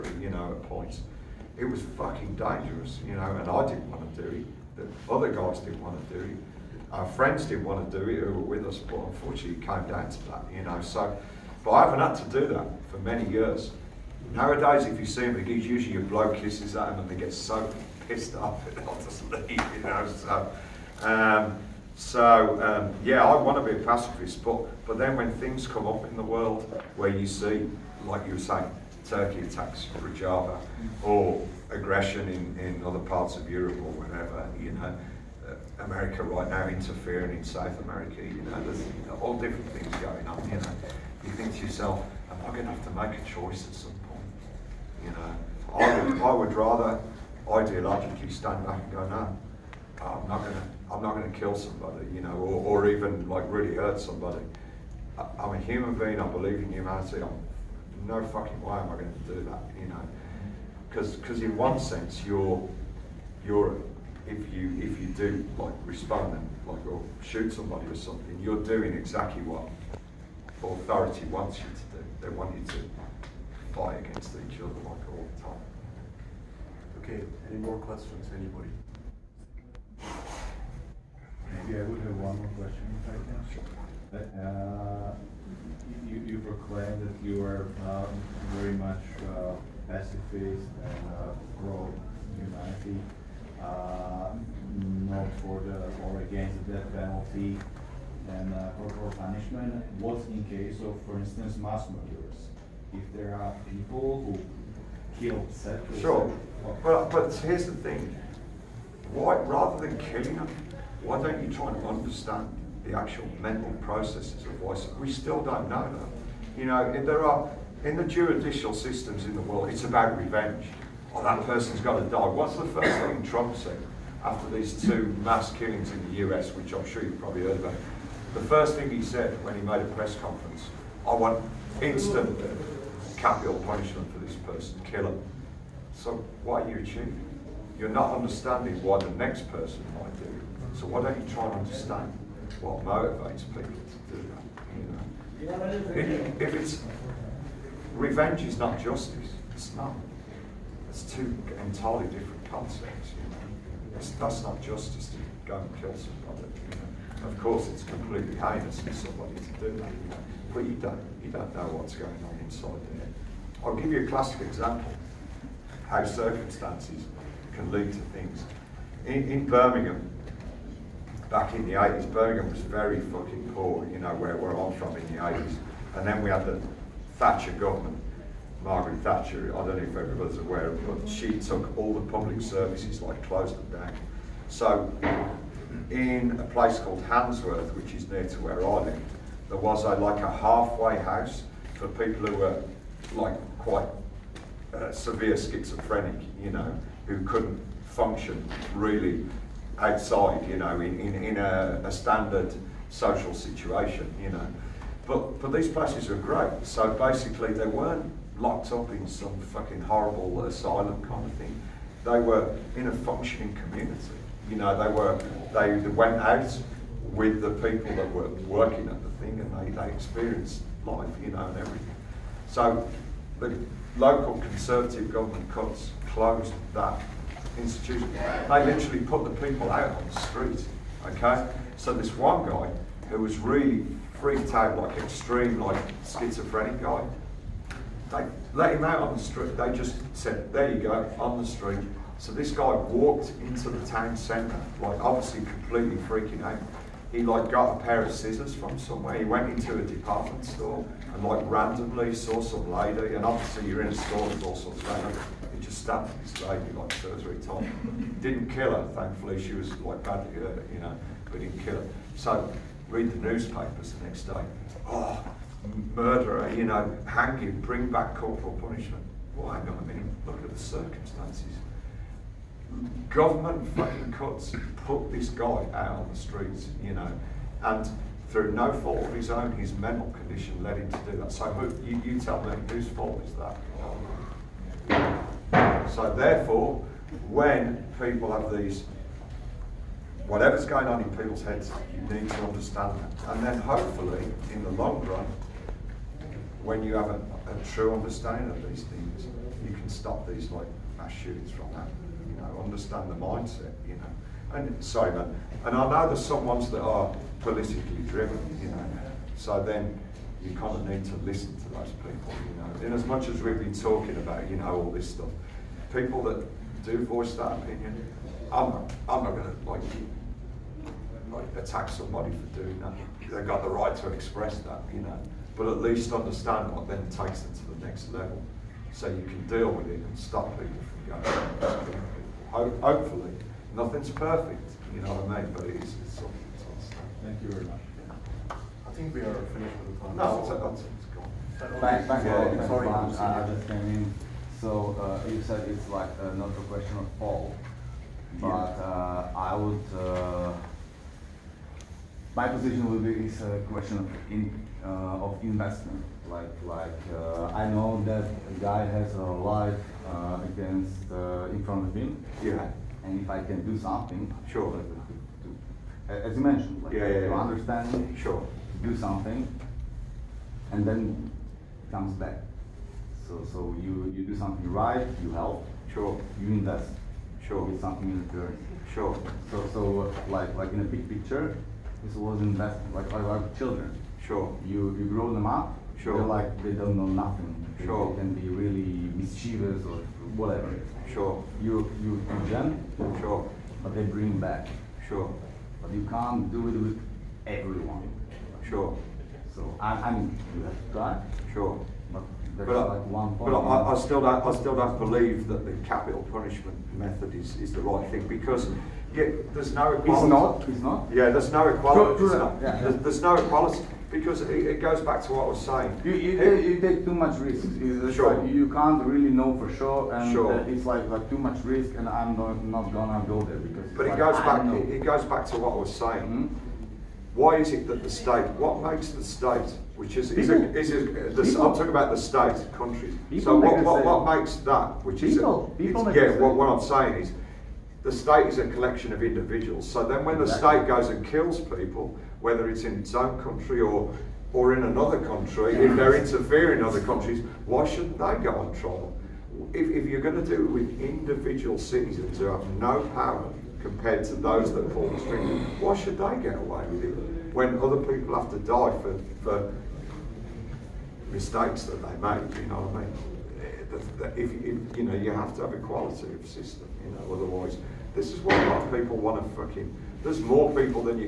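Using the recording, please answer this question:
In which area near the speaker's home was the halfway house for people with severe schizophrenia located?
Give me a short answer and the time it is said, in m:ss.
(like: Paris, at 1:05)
Handsworth, at 3:07.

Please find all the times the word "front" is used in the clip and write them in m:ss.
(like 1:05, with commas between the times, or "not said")
6:01.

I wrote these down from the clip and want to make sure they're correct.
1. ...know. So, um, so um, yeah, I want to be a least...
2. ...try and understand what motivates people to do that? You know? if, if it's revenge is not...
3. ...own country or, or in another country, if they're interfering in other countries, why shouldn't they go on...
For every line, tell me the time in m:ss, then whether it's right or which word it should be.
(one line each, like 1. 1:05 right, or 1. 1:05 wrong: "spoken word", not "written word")
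1. 0:19 wrong: "pacifist", not "least"
2. 2:21 right
3. 7:23 right.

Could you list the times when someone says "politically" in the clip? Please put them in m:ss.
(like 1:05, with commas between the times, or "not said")
5:07.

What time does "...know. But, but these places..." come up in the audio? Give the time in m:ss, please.
3:24.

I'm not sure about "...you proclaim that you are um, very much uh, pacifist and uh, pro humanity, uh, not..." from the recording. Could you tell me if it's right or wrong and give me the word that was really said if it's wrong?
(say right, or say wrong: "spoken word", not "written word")
right.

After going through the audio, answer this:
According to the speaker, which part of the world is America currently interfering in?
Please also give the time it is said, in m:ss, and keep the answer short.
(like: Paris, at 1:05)
South America, at 0:37.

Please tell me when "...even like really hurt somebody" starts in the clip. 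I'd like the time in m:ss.
0:52.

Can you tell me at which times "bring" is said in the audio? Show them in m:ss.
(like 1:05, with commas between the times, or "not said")
4:27, 6:34.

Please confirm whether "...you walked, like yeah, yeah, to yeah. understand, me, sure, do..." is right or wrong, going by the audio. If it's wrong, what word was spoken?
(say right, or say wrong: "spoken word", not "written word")
wrong: "mentioned", not "walked".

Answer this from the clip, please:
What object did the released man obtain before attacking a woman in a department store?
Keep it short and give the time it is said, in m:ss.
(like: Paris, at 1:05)
A pair of scissors, at 4:07.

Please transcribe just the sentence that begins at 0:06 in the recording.
Our friends didn't want to do it who were with us, but unfortunately it came down to that, you know.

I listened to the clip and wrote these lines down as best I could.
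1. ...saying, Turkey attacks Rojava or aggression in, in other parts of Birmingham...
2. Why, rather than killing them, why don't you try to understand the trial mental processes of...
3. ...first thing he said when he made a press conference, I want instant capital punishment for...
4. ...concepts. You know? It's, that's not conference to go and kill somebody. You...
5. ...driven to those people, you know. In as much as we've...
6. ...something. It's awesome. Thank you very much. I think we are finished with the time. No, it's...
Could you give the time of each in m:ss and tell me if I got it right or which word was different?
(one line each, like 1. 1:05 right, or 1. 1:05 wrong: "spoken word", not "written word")
1. 0:28 wrong: "Europe", not "Birmingham"
2. 1:49 wrong: "actual", not "trial"
3. 2:08 right
4. 2:32 wrong: "justice", not "conference"
5. 5:11 wrong: "listen", not "driven"
6. 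5:36 right.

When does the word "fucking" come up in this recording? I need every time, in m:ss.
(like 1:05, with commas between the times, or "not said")
0:01, 0:58, 2:53, 3:29, 4:33, 7:49.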